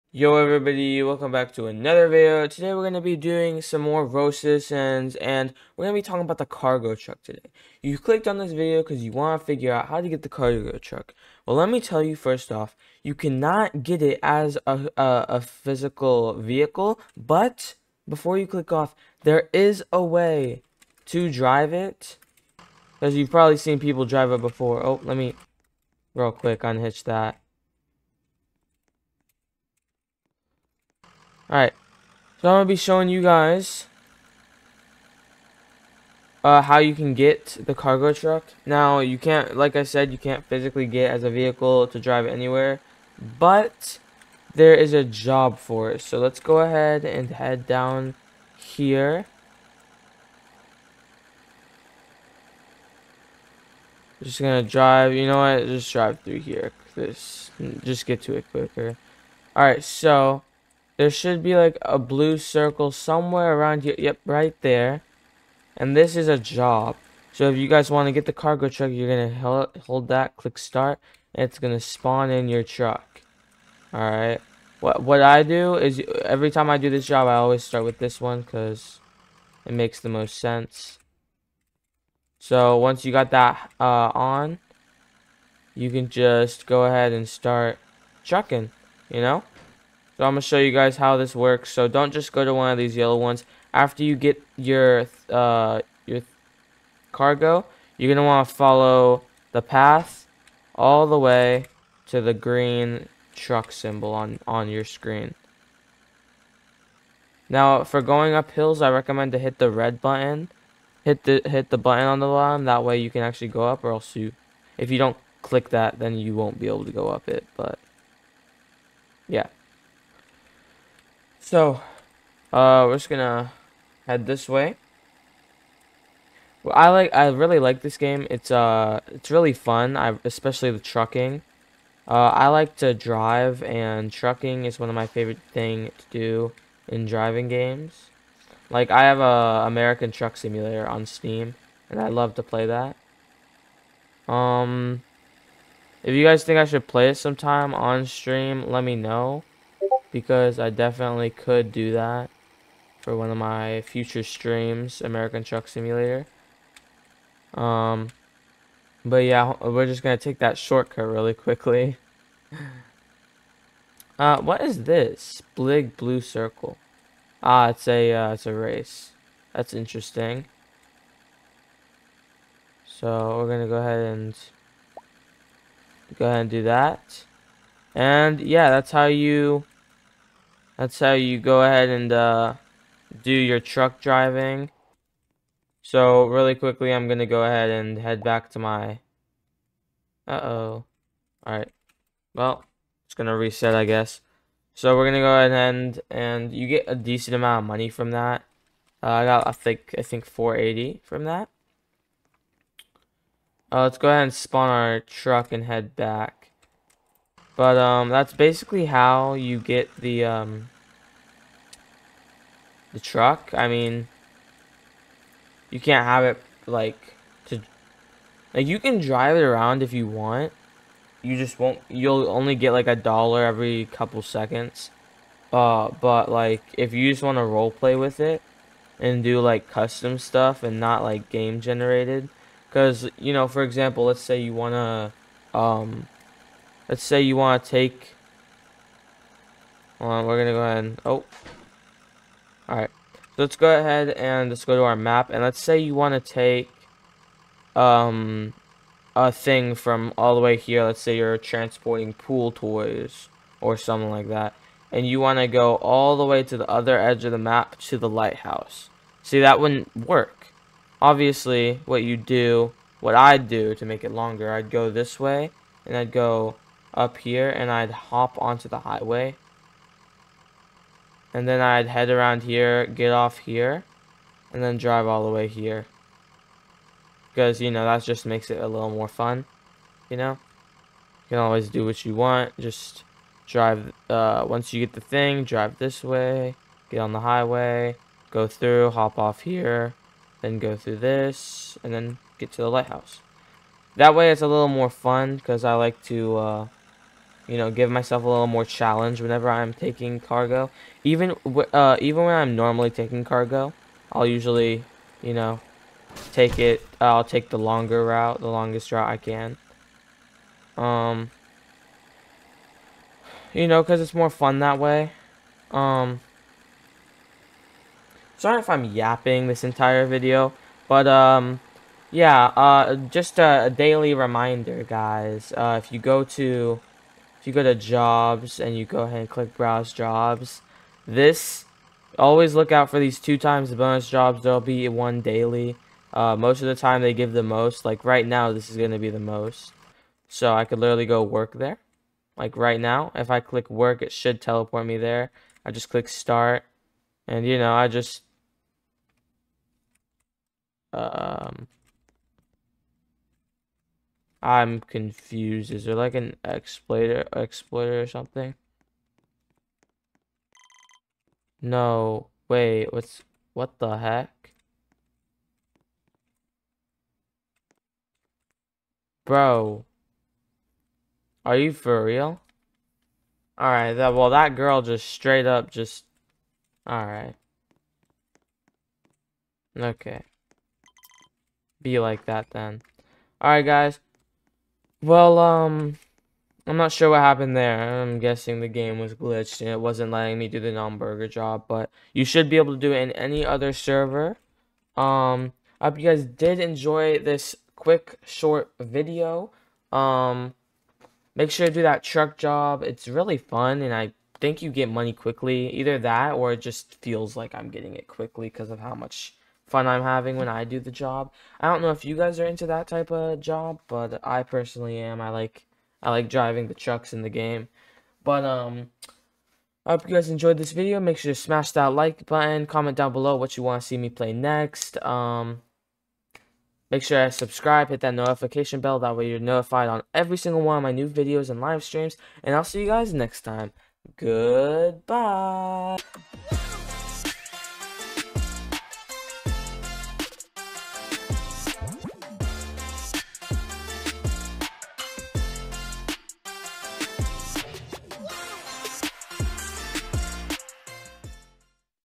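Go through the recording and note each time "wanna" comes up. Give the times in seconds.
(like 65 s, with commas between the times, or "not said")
234 s.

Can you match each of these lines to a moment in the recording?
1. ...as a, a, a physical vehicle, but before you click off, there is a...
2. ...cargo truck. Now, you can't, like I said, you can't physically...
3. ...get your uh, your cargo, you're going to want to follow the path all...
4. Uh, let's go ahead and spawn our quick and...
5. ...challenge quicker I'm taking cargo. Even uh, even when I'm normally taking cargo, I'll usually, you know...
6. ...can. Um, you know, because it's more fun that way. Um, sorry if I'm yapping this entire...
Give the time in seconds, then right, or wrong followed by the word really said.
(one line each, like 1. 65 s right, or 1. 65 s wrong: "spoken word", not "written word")
1. 14 s right
2. 37 s right
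3. 94 s right
4. 203 s wrong: "truck", not "quick"
5. 298 s wrong: "whenever", not "quicker"
6. 309 s right.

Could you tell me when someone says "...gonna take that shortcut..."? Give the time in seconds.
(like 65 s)
160 s.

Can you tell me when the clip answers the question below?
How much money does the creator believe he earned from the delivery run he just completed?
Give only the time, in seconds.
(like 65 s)
200 s.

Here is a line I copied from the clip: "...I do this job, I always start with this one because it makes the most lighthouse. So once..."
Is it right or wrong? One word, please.
wrong.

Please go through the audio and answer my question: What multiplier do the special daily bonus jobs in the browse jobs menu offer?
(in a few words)
2 times.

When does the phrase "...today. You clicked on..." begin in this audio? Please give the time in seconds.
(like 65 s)
7 s.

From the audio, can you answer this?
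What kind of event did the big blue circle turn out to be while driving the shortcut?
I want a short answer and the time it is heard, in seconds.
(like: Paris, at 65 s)
a race, at 168 s.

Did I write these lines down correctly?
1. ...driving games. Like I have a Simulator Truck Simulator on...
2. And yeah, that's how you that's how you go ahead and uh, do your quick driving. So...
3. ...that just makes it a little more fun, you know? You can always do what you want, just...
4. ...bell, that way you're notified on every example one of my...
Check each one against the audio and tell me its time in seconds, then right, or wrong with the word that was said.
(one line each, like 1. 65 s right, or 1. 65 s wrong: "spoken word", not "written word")
1. 137 s wrong: "American", not "Simulator"
2. 177 s wrong: "truck", not "quick"
3. 277 s right
4. 428 s wrong: "single", not "example".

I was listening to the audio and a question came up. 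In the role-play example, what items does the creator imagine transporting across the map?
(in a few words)
pool toys.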